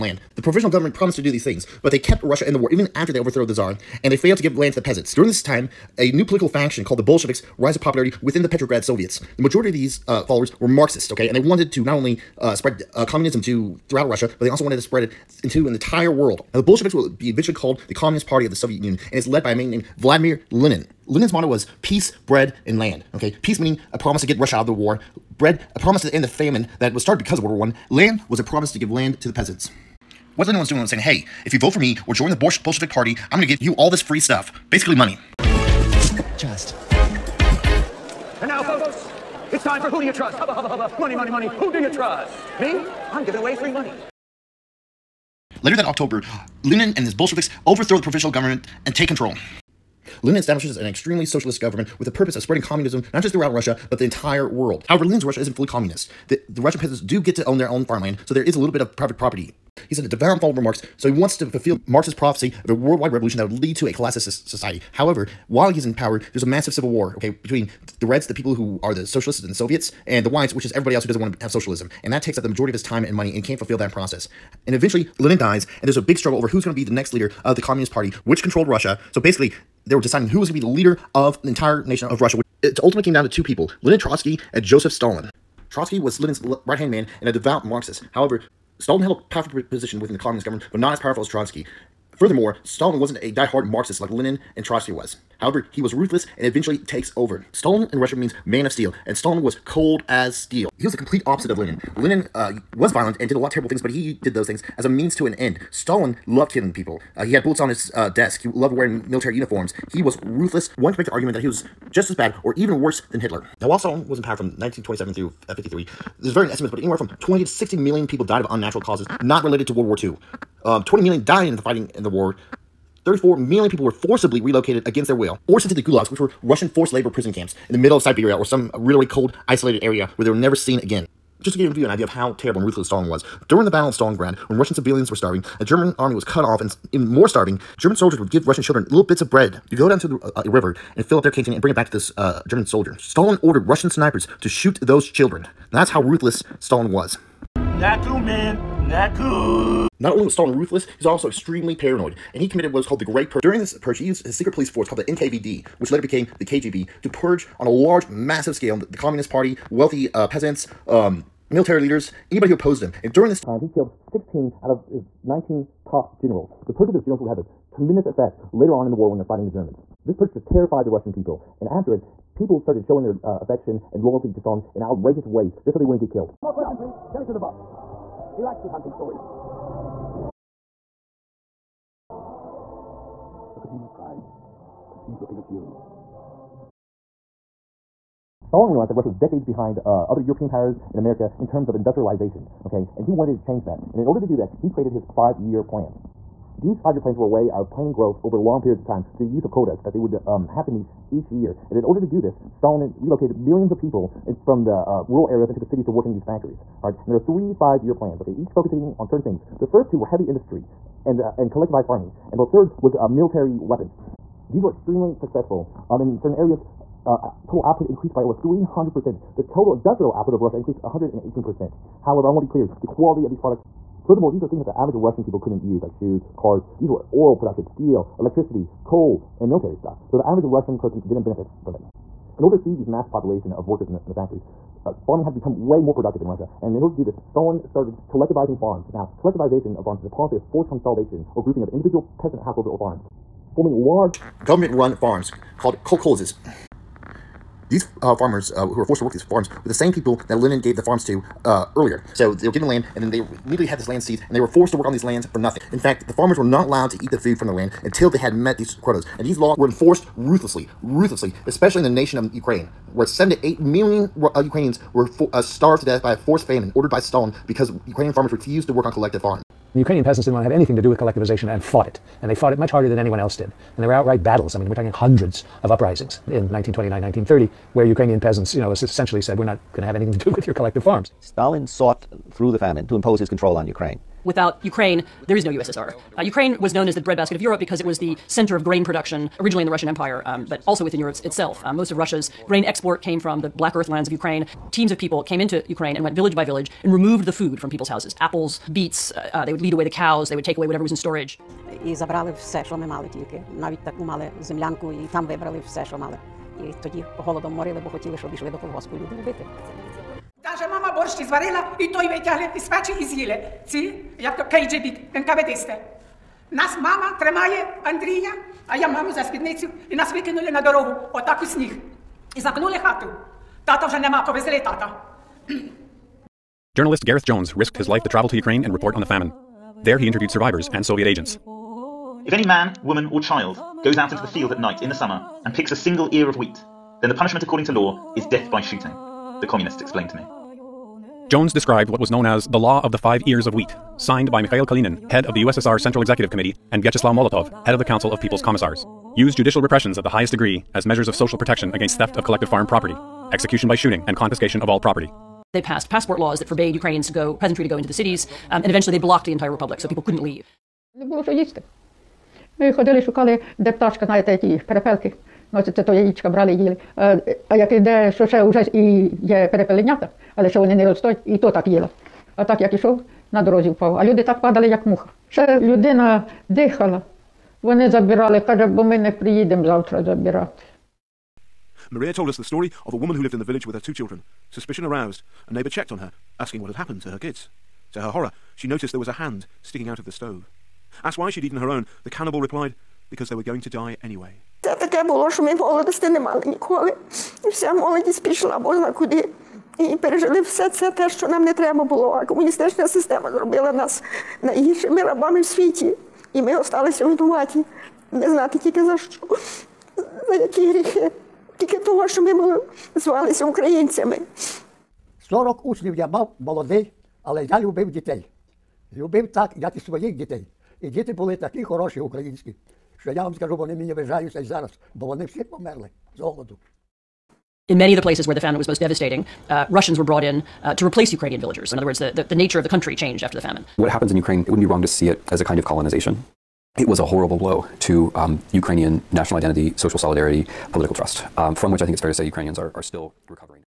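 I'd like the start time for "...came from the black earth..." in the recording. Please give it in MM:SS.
04:53.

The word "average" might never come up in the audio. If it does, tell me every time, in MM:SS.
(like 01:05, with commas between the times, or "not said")
03:44, 03:50.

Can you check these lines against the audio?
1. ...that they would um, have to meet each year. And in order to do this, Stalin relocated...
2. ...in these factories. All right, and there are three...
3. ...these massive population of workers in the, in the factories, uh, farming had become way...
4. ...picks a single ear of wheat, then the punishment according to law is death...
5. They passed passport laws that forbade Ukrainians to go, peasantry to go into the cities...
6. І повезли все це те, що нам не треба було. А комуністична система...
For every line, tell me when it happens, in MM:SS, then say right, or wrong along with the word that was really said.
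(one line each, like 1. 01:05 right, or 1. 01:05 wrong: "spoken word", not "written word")
1. 03:19 right
2. 03:26 right
3. 03:52 right
4. 05:35 right
5. 05:55 right
6. 06:39 wrong: "пережили", not "повезли".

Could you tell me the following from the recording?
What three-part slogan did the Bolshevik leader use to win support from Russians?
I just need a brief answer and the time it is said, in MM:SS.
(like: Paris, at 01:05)
Peace, bread, and land, at 00:21.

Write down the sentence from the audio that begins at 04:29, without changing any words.
The Ukrainian peasants didn't want to have anything to do with collectivization and fought it.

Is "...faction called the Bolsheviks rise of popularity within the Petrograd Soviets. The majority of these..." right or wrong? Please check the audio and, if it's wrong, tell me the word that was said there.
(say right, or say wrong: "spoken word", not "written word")
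right.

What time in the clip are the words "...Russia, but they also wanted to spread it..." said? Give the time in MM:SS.
00:14.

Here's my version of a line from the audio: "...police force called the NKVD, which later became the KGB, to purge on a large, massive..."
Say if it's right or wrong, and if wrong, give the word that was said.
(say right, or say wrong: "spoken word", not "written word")
right.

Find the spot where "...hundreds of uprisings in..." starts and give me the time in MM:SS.
04:34.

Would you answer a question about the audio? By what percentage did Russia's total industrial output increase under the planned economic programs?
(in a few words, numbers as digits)
118%.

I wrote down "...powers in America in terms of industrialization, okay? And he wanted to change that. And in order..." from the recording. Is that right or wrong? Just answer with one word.
right.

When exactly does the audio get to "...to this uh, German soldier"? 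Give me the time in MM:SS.
02:21.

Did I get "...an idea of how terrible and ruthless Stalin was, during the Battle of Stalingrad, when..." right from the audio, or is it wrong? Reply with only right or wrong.
right.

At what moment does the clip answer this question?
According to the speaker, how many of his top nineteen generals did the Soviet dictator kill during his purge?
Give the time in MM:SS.
02:43.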